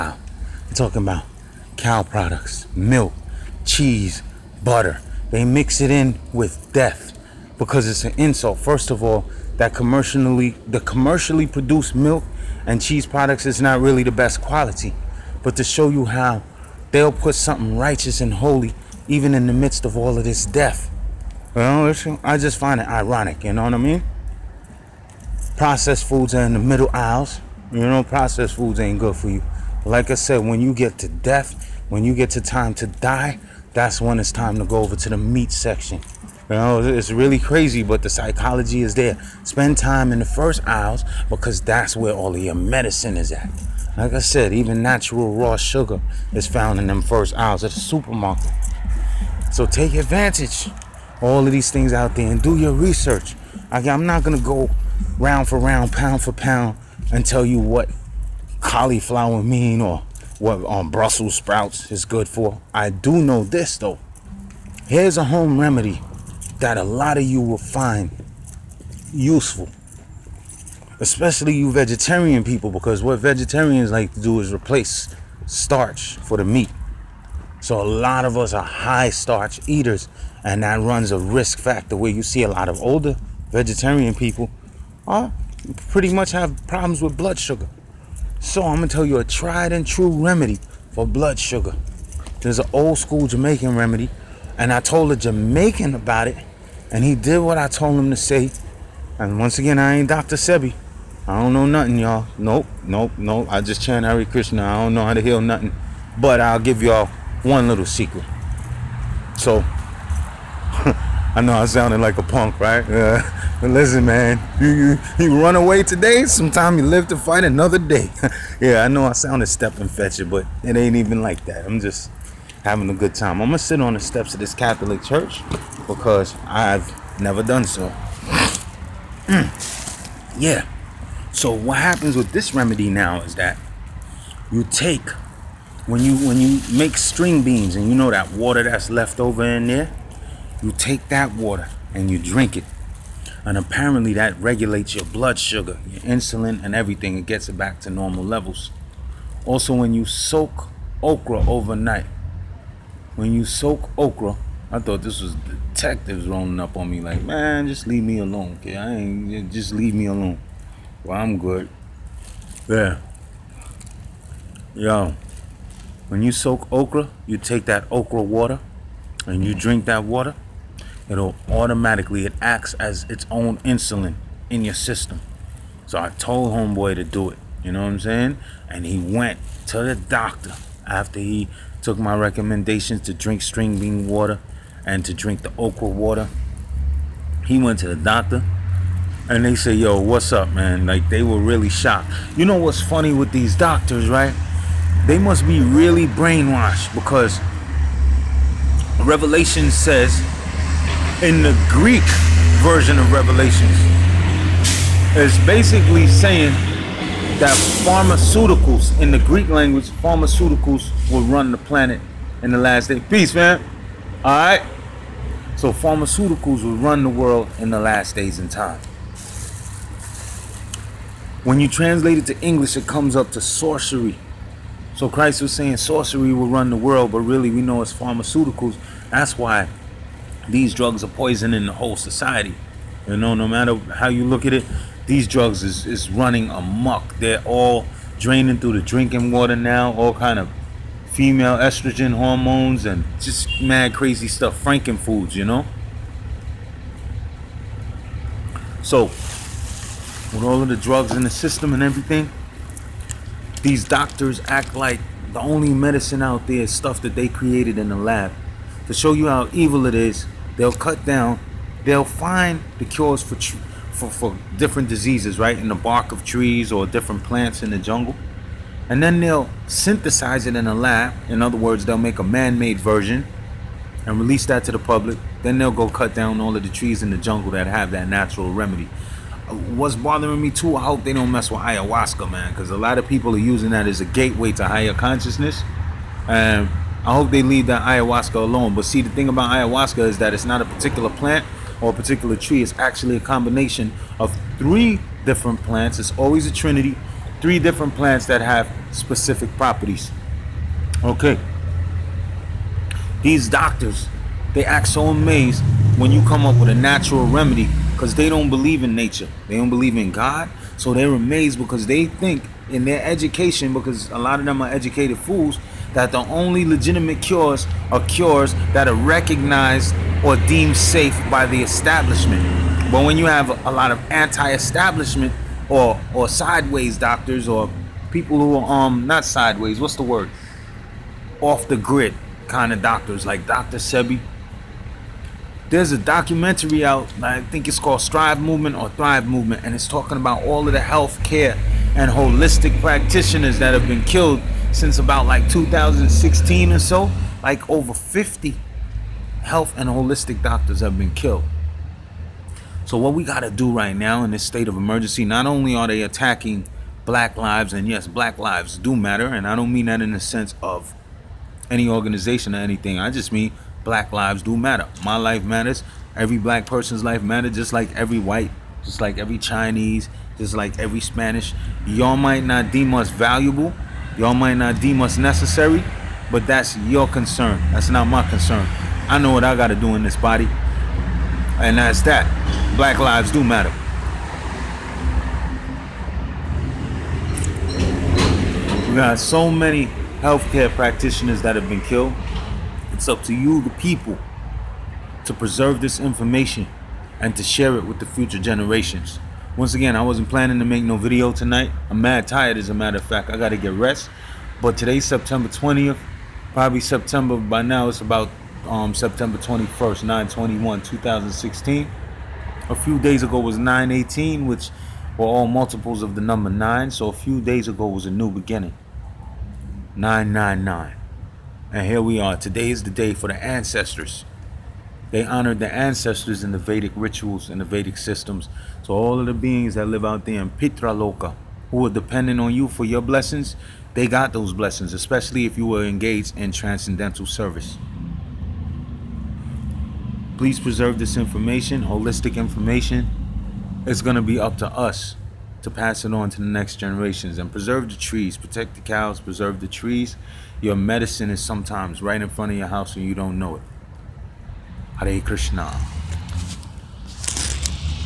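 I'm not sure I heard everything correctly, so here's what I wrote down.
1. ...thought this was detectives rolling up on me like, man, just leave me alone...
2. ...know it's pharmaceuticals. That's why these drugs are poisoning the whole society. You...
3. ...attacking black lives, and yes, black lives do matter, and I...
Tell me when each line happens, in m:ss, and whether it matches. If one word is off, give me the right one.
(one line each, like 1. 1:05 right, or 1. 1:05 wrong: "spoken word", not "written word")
1. 2:34 right
2. 3:47 right
3. 5:56 right.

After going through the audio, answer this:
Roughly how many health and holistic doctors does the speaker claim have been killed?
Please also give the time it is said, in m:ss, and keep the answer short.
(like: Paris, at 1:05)
Over 50, at 5:47.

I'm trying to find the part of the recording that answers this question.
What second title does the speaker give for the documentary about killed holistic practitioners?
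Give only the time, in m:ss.
5:38.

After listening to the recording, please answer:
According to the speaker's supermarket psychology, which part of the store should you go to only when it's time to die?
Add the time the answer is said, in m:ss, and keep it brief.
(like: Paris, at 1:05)
The meat section, at 0:35.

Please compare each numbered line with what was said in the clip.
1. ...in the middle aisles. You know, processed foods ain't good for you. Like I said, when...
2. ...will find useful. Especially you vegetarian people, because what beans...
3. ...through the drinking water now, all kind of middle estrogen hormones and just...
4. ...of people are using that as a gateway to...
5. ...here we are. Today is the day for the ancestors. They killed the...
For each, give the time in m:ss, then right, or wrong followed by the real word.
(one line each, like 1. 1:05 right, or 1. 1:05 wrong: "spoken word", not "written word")
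1. 0:26 right
2. 1:07 wrong: "vegetarians", not "beans"
3. 3:58 wrong: "female", not "middle"
4. 4:42 right
5. 7:01 wrong: "honored", not "killed".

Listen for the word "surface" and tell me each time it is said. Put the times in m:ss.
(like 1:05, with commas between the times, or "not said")
not said.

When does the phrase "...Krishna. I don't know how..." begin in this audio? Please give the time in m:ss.
1:44.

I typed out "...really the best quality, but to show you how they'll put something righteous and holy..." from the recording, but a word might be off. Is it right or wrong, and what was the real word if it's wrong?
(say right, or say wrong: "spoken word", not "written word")
right.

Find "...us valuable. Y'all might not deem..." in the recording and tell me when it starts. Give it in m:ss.
6:12.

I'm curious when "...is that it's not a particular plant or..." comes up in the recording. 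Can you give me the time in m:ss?
4:49.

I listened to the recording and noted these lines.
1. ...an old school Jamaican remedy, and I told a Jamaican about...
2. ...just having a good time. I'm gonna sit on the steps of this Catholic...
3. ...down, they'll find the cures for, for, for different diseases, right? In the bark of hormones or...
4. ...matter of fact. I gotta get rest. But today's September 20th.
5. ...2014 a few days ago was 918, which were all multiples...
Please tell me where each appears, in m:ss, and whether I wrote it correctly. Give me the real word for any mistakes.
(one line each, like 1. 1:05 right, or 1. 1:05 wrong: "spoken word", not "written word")
1. 1:32 right
2. 2:01 right
3. 4:21 wrong: "trees", not "hormones"
4. 6:42 right
5. 6:50 wrong: "2016", not "2014".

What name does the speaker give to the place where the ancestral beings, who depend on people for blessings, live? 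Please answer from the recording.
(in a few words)
Pitraloka.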